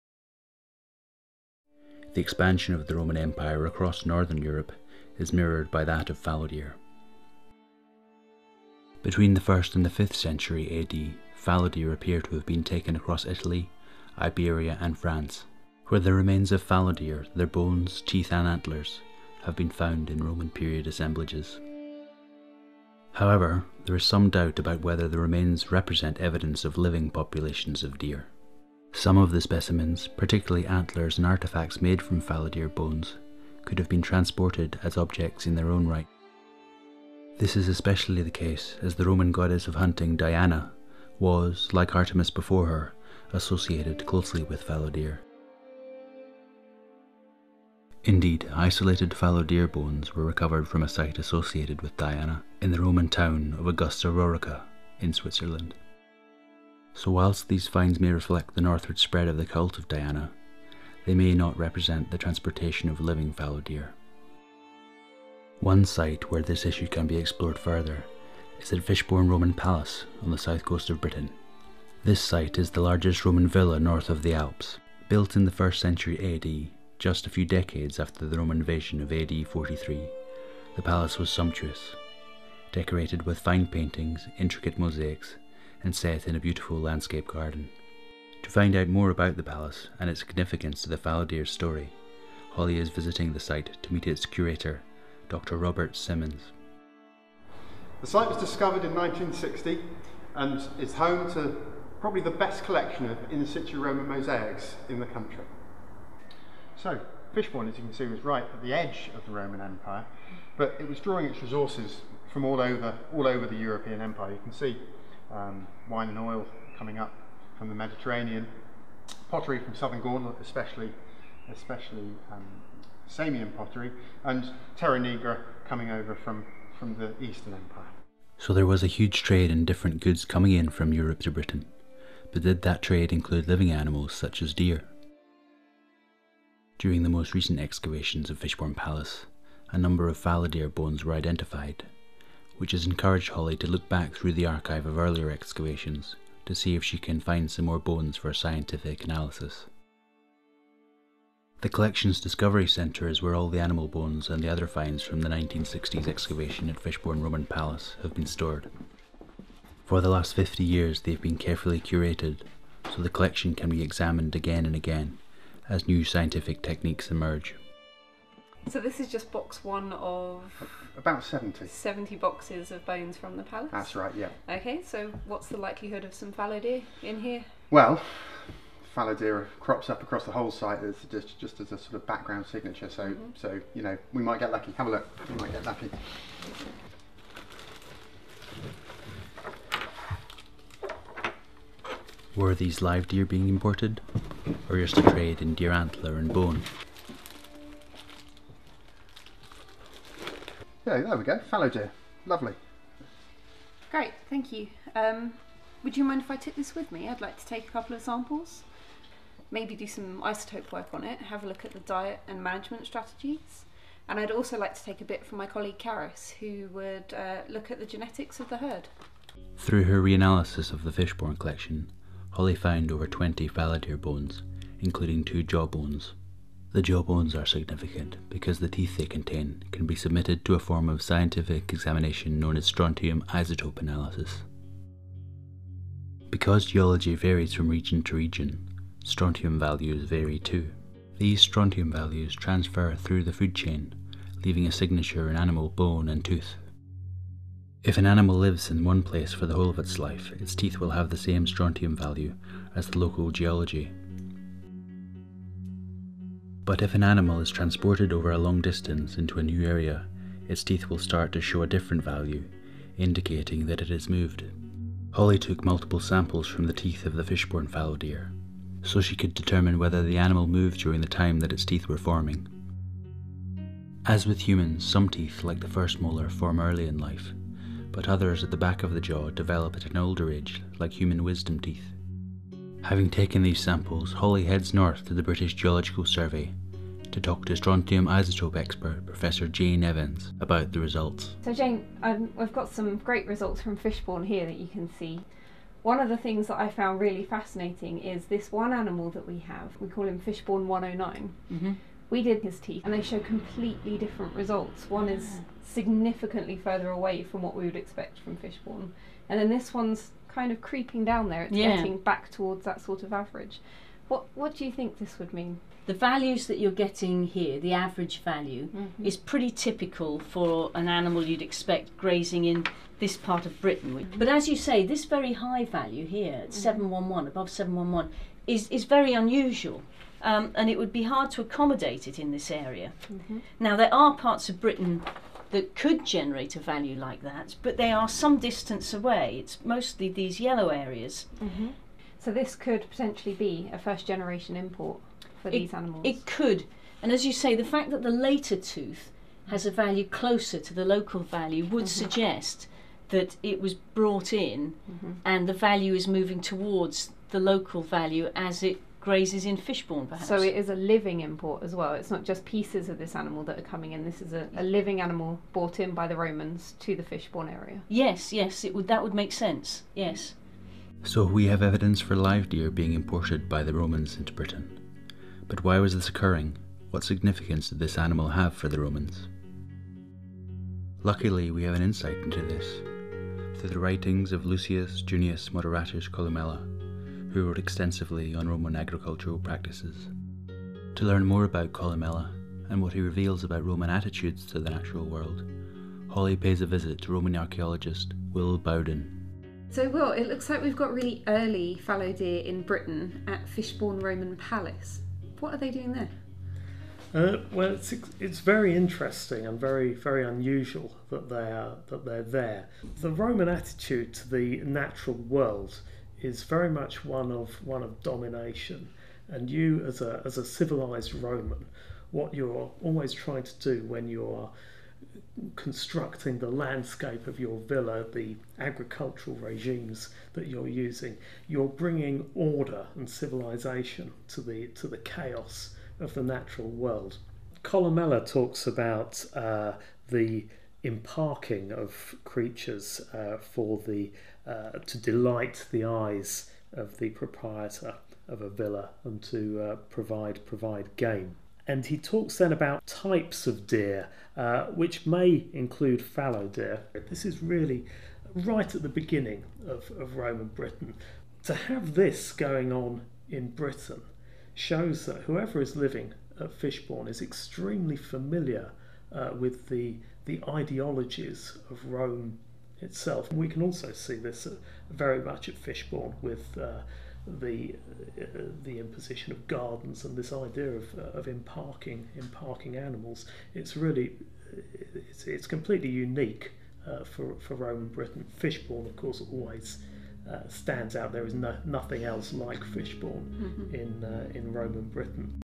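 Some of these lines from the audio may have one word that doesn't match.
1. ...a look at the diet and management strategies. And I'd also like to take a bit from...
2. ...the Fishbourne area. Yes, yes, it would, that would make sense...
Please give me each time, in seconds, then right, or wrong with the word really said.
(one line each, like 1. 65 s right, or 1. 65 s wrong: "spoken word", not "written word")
1. 211 s right
2. 366 s right.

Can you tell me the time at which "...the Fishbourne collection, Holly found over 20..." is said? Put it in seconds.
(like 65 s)
220 s.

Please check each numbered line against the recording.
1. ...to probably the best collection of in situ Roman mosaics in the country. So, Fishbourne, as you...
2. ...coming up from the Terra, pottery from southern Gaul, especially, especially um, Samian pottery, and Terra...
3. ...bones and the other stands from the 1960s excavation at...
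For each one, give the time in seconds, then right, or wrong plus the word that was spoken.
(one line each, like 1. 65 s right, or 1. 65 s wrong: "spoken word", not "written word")
1. 101 s right
2. 116 s wrong: "Mediterranean", not "Terra"
3. 153 s wrong: "finds", not "stands".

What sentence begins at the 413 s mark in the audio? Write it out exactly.
The Roman attitude to the natural world is very much one of one of domination.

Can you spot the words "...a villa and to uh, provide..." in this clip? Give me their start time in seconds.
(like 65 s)
448 s.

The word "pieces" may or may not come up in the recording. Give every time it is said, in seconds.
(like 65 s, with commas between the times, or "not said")
362 s.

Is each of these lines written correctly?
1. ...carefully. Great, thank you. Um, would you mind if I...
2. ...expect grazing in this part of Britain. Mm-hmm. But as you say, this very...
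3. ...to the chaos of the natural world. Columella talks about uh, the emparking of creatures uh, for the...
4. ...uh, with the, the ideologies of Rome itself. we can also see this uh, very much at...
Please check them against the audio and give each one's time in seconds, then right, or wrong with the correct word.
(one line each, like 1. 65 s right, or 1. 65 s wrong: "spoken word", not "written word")
1. 202 s wrong: "lovely", not "carefully"
2. 321 s right
3. 434 s right
4. 469 s right.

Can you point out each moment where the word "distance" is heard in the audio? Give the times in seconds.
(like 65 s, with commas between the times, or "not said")
258 s, 338 s.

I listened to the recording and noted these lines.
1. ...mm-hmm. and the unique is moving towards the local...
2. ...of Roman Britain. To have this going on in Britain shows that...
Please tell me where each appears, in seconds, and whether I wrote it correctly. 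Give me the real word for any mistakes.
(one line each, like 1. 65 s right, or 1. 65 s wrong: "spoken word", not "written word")
1. 354 s wrong: "value", not "unique"
2. 459 s right.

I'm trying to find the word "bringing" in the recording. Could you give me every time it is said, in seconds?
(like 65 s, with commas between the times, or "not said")
431 s.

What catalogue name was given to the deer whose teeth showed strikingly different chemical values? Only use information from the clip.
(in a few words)
Fishbourne 109.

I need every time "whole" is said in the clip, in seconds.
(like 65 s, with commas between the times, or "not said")
180 s, 249 s.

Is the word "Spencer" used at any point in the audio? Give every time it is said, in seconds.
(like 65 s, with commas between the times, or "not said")
not said.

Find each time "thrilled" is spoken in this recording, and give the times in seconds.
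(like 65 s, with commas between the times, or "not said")
not said.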